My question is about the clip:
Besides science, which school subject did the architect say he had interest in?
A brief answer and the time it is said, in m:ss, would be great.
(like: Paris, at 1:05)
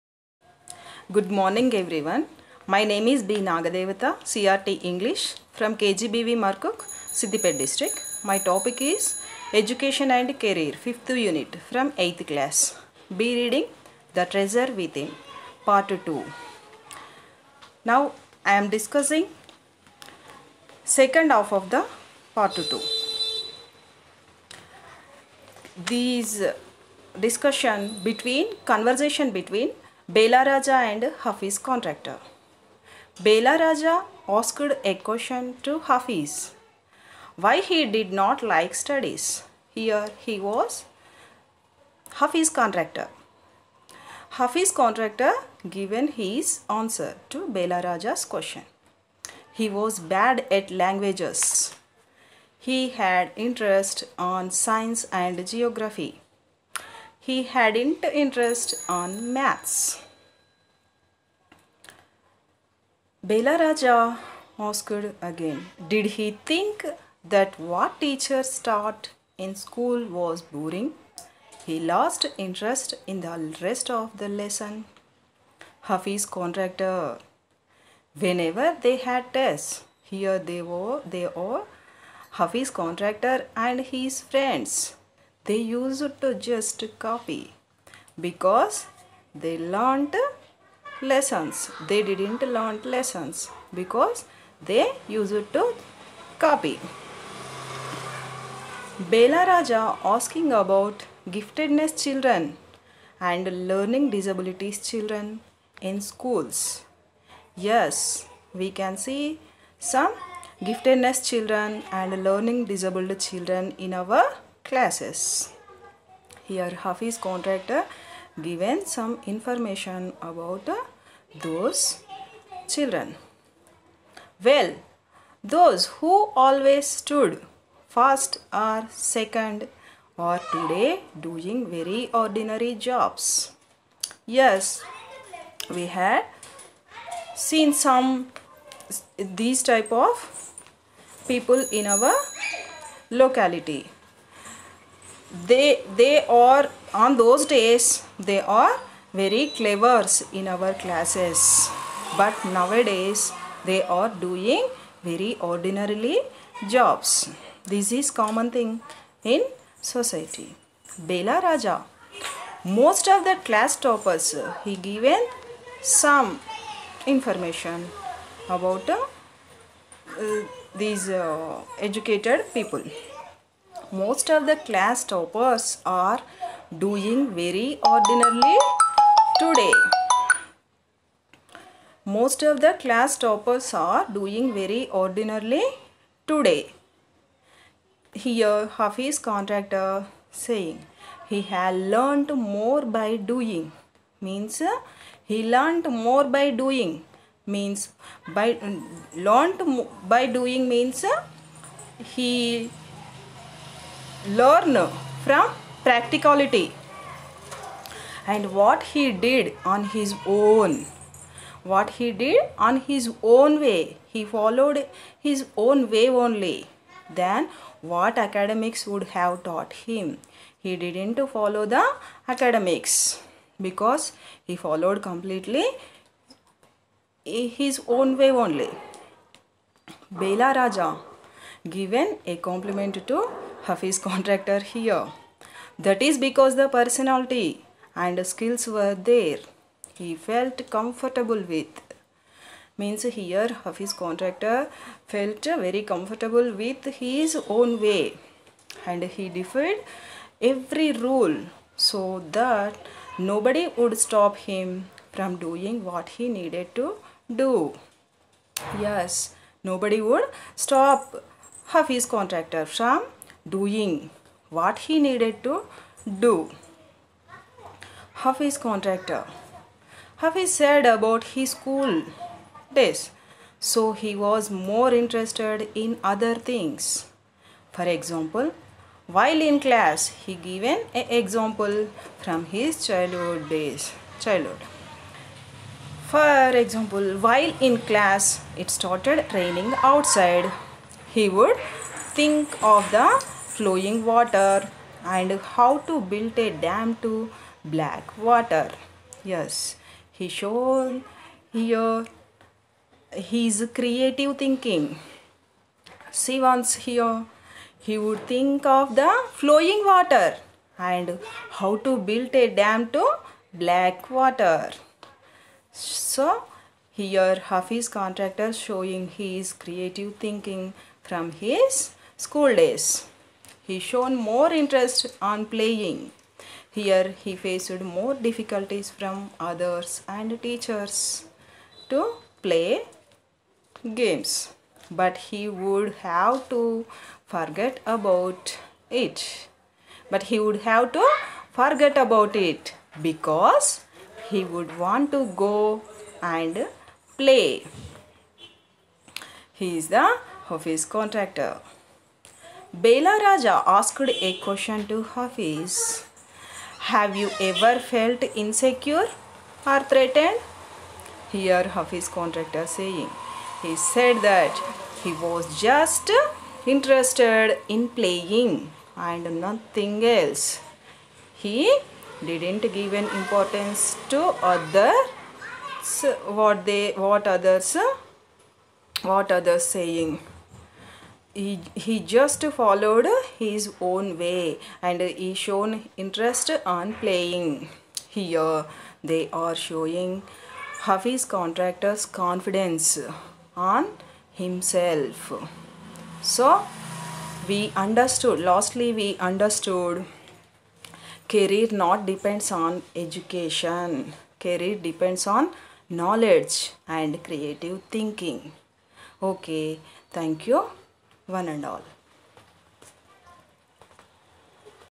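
Geography, at 0:55.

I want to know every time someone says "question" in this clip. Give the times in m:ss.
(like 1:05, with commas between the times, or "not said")
0:34, 0:48, 5:54.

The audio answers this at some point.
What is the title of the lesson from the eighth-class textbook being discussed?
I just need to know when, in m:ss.
0:14.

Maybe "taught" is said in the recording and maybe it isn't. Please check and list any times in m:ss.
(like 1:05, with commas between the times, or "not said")
1:08, 3:39.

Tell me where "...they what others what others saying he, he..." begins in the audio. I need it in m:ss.
6:16.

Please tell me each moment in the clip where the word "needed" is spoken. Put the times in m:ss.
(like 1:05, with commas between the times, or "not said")
4:16, 4:24.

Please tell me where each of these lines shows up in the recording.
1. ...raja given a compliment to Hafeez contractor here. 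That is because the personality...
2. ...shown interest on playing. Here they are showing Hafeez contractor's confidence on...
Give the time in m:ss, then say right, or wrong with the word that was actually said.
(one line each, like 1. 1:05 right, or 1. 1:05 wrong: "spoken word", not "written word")
1. 3:50 right
2. 6:25 right.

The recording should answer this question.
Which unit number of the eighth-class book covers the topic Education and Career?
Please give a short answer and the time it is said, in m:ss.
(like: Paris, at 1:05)
5, at 0:10.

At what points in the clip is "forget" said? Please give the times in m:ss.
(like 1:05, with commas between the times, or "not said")
5:37, 5:41.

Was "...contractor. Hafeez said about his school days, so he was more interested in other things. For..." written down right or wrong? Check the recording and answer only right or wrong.
right.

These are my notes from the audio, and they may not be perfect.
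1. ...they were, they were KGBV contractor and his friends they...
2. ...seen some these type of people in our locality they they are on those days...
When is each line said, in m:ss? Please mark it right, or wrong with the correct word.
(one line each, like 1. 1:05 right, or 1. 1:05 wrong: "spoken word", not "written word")
1. 1:20 wrong: "Hafeez", not "KGBV"
2. 2:17 right.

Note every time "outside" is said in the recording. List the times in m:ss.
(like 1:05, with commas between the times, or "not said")
4:49.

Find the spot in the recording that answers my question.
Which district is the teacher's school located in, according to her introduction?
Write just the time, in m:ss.
0:07.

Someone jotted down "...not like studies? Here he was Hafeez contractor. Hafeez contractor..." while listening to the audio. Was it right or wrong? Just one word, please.
right.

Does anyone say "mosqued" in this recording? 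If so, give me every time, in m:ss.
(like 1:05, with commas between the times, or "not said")
1:04.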